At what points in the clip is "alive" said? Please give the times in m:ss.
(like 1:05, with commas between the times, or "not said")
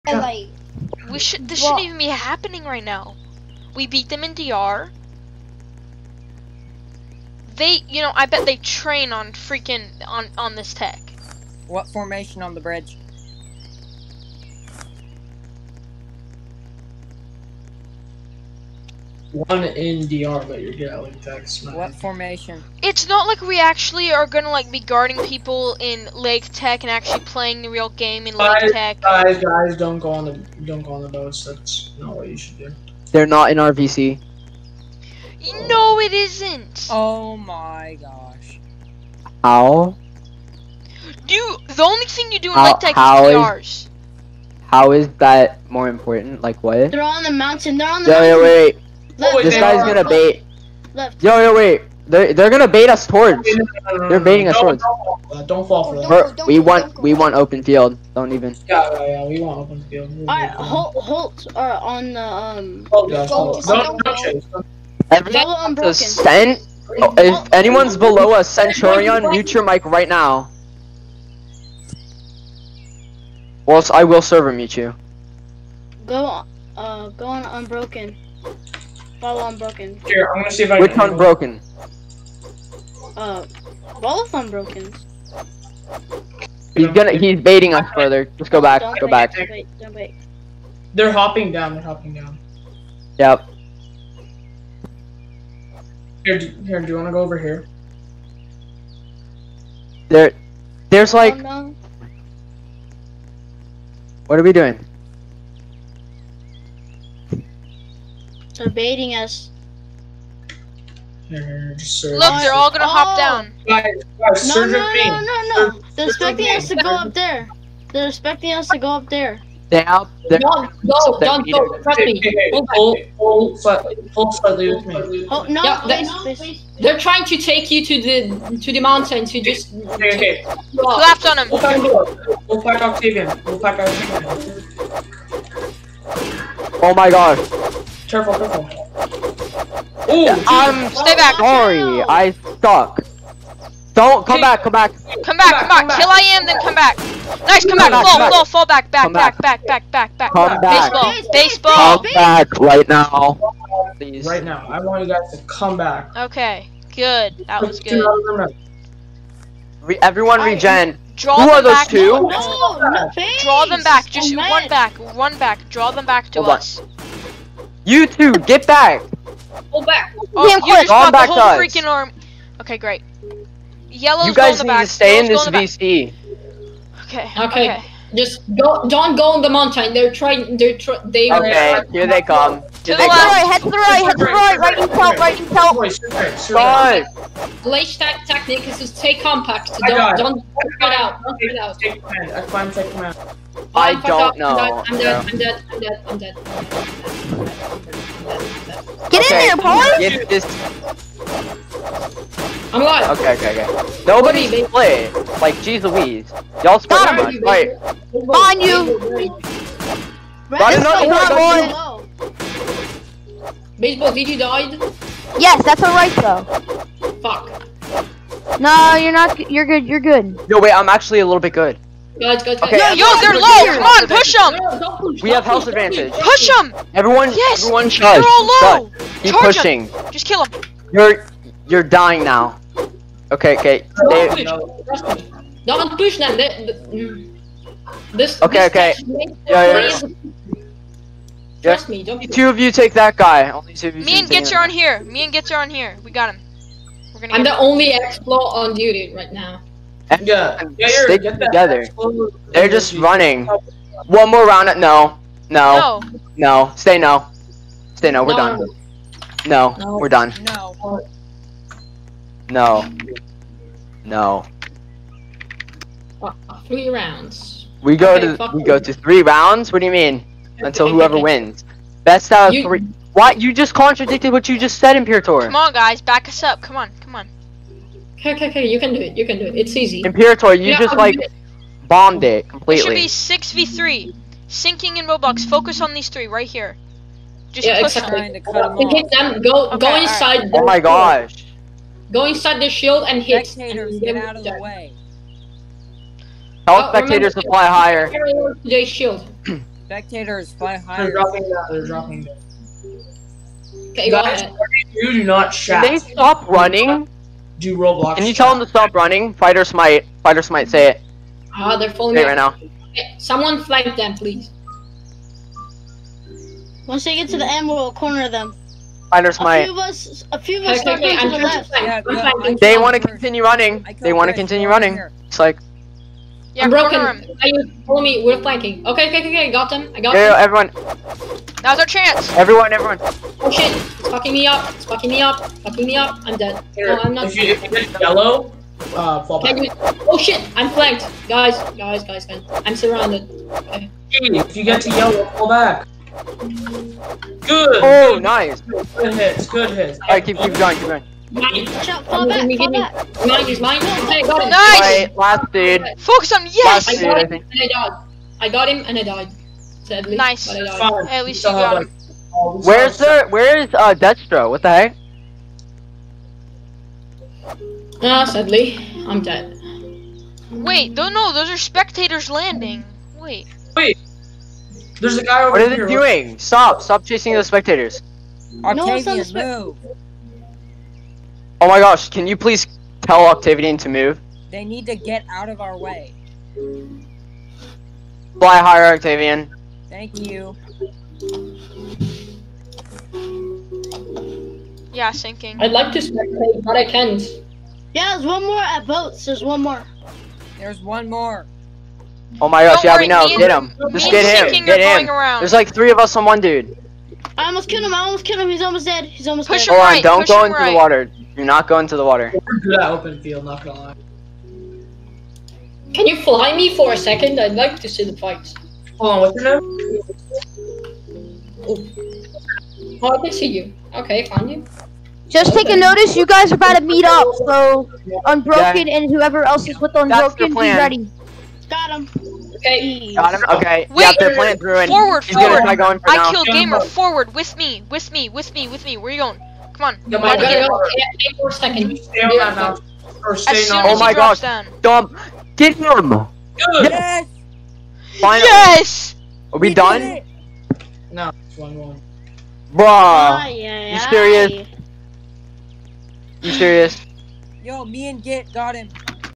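3:22.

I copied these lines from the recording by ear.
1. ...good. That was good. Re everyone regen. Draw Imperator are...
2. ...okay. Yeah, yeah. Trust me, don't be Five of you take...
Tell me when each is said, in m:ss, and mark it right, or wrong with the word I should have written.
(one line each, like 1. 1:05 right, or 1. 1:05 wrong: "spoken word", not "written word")
1. 2:36 wrong: "Who", not "Imperator"
2. 3:59 wrong: "Two", not "Five".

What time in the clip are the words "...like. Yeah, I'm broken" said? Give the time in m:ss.
5:25.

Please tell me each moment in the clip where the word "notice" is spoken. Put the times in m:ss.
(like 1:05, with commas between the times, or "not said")
7:05.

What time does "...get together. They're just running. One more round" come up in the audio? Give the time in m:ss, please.
4:11.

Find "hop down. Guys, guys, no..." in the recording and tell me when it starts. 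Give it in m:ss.
1:52.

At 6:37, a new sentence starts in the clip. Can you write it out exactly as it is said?
Yeah, there's one more at boats.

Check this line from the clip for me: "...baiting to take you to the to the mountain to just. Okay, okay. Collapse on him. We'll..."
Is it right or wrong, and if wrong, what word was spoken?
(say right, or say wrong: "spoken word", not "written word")
wrong: "trying", not "baiting".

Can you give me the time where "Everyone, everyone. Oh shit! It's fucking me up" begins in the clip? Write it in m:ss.
5:32.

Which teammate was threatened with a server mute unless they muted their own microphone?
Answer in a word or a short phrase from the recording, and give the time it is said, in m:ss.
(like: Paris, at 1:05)
Centurion, at 1:08.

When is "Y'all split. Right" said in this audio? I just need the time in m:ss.
3:26.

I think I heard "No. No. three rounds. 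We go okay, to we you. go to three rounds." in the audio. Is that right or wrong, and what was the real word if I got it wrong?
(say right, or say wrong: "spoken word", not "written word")
right.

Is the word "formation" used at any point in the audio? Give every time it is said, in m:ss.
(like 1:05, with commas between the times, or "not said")
0:11, 0:21.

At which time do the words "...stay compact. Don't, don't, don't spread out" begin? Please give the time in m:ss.
3:08.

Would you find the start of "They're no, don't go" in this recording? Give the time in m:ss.
1:59.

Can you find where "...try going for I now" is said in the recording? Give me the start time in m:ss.
7:15.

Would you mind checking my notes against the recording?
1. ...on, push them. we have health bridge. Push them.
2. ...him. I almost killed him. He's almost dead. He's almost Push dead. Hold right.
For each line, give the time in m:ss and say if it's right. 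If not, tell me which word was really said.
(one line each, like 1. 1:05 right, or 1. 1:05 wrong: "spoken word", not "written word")
1. 3:43 wrong: "advantage", not "bridge"
2. 6:47 right.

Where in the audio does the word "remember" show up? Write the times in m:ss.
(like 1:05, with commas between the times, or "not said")
4:57.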